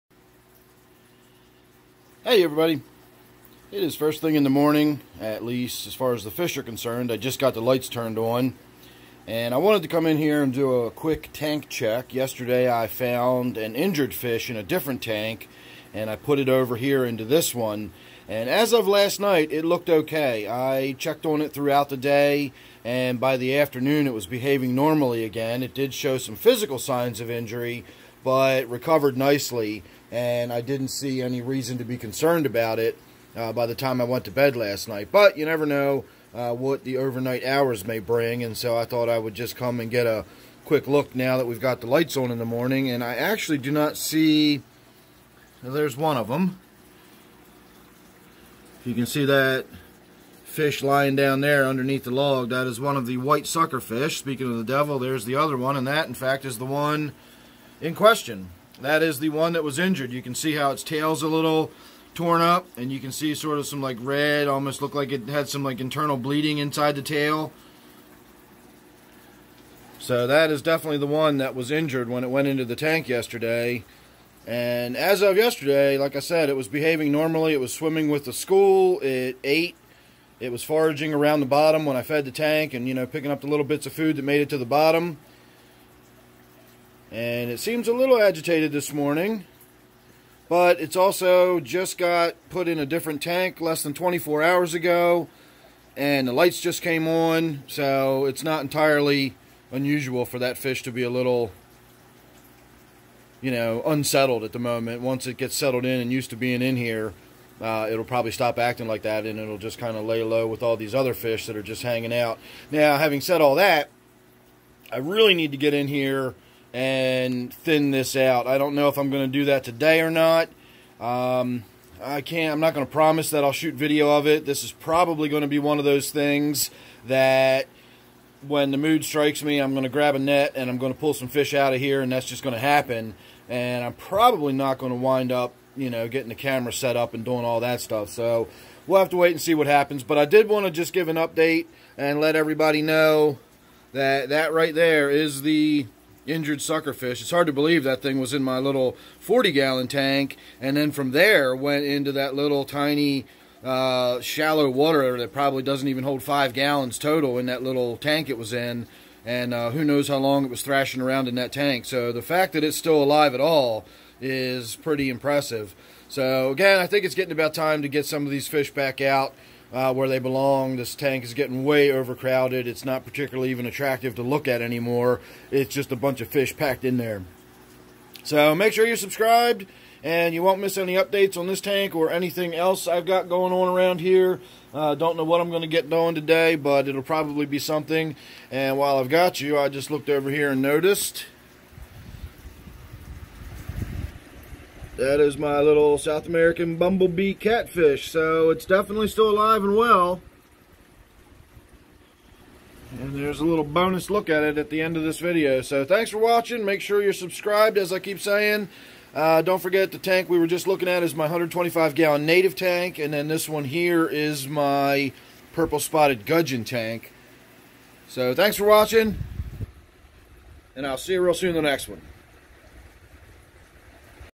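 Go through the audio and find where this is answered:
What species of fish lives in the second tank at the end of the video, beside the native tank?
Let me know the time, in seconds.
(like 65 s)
215 s.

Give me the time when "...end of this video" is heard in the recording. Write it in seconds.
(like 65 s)
204 s.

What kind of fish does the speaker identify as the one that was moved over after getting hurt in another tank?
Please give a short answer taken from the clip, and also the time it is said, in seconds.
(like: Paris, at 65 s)
white sucker, at 53 s.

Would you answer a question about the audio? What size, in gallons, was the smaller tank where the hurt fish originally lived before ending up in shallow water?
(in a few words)
40.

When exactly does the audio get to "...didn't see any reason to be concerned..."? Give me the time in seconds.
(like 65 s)
30 s.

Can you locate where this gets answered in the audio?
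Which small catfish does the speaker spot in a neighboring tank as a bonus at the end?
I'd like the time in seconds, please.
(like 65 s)
195 s.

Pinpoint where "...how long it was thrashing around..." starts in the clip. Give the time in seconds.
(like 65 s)
160 s.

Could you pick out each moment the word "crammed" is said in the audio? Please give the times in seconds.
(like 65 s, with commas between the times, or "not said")
not said.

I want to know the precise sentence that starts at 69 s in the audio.
So that is definitely the one that was injured when it went into the tank yesterday.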